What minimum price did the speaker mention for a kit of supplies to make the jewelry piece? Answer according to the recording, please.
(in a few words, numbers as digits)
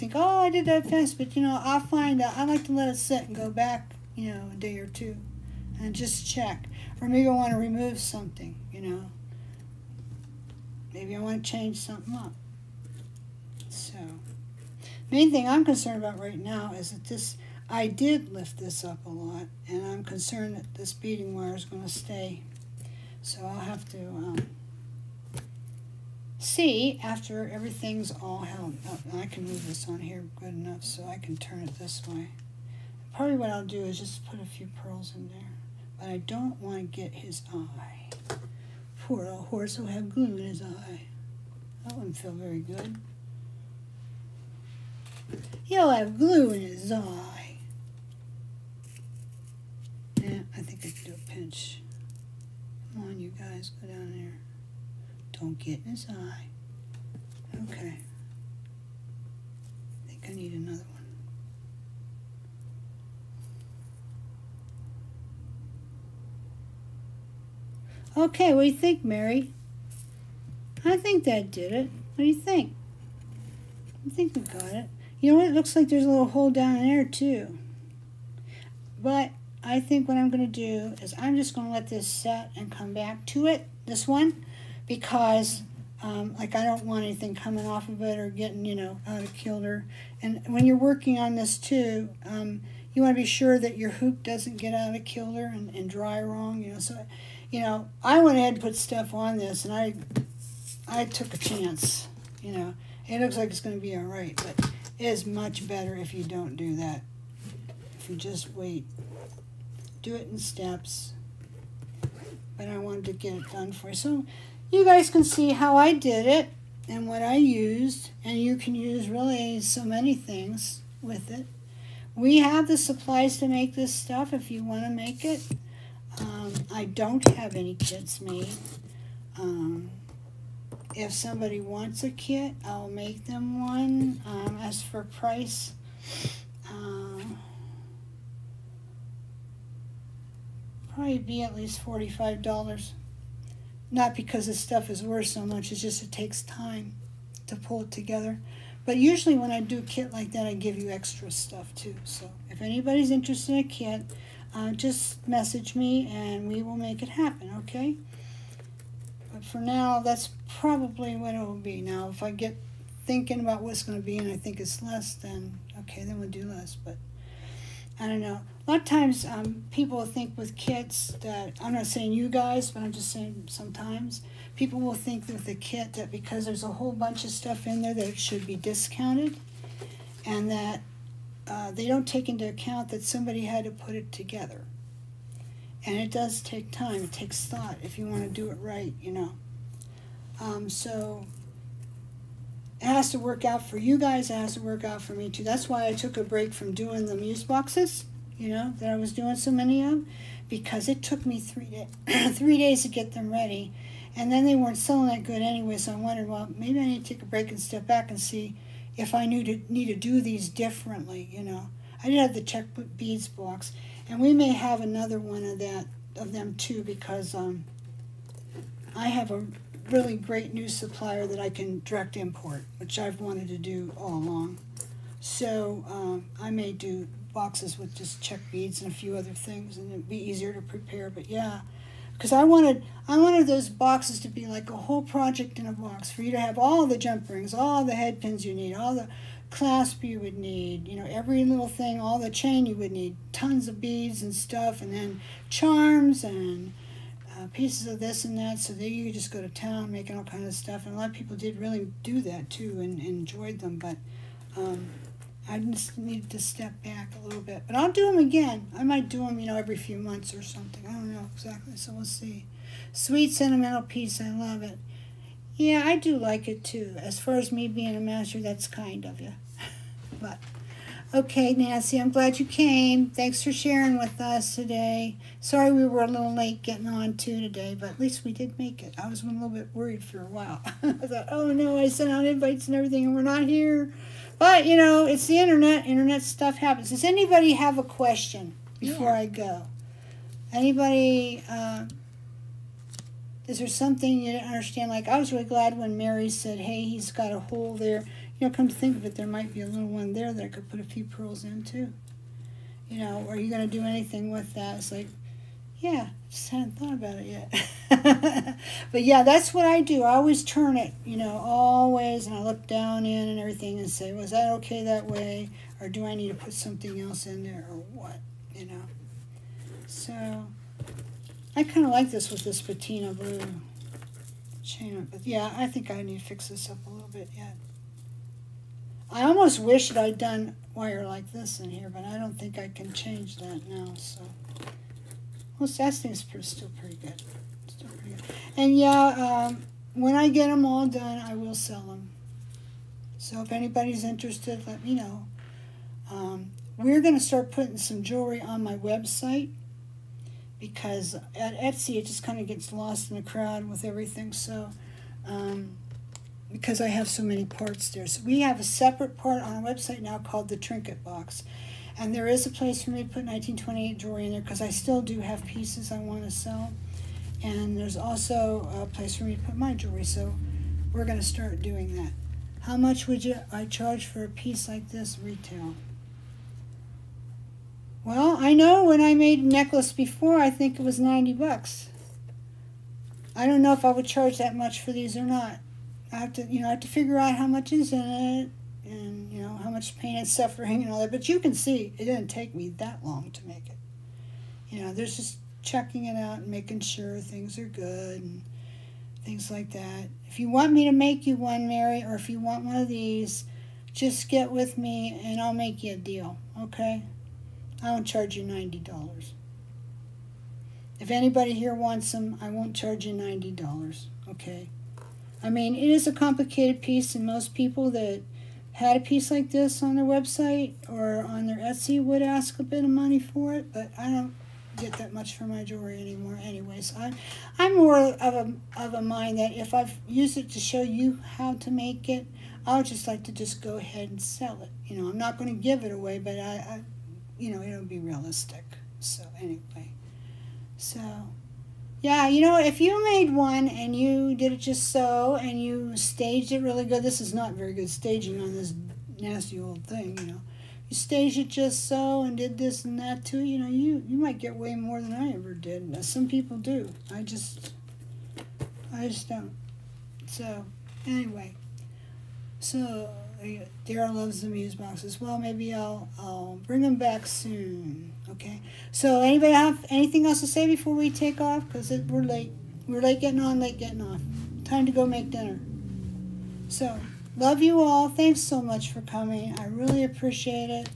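$45.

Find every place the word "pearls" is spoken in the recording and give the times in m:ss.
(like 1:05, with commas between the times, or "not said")
0:34, 5:01.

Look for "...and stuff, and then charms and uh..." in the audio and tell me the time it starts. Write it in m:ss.
4:04.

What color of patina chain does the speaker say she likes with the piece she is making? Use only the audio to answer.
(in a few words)
blue.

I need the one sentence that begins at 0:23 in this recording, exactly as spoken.
So I'll have to, um, see after everything's all held up.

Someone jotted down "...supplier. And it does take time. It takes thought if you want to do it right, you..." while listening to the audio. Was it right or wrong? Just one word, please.
wrong.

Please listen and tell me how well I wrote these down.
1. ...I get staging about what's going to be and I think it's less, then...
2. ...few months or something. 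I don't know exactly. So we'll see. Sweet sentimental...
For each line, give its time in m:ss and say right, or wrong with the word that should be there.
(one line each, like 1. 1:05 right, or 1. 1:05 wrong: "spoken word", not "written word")
1. 2:42 wrong: "thinking", not "staging"
2. 4:19 right.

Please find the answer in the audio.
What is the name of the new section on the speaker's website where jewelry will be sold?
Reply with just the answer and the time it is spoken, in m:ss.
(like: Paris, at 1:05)
the Trinket Box, at 6:00.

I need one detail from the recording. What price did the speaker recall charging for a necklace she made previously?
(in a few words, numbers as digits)
$90.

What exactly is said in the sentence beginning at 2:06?
Um, I don't have any kits made.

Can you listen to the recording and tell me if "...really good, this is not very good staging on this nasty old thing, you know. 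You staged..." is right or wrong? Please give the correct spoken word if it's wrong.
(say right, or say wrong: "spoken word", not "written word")
right.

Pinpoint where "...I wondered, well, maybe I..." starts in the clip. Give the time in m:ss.
3:25.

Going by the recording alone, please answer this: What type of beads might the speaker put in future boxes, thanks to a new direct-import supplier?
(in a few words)
Czech beads.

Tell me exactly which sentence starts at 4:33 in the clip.
Thanks for sharing with us today.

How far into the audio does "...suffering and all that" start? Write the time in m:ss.
6:30.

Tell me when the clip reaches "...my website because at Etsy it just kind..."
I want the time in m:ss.
5:48.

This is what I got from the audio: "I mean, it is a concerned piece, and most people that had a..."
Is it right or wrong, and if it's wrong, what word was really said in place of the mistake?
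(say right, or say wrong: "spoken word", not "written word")
wrong: "complicated", not "concerned".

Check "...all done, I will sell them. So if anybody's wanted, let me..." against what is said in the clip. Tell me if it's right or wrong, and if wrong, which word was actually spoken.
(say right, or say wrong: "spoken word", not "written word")
wrong: "interested", not "wanted".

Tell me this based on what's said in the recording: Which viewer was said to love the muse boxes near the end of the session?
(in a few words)
Daryl.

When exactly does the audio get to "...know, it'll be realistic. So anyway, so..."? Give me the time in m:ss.
7:17.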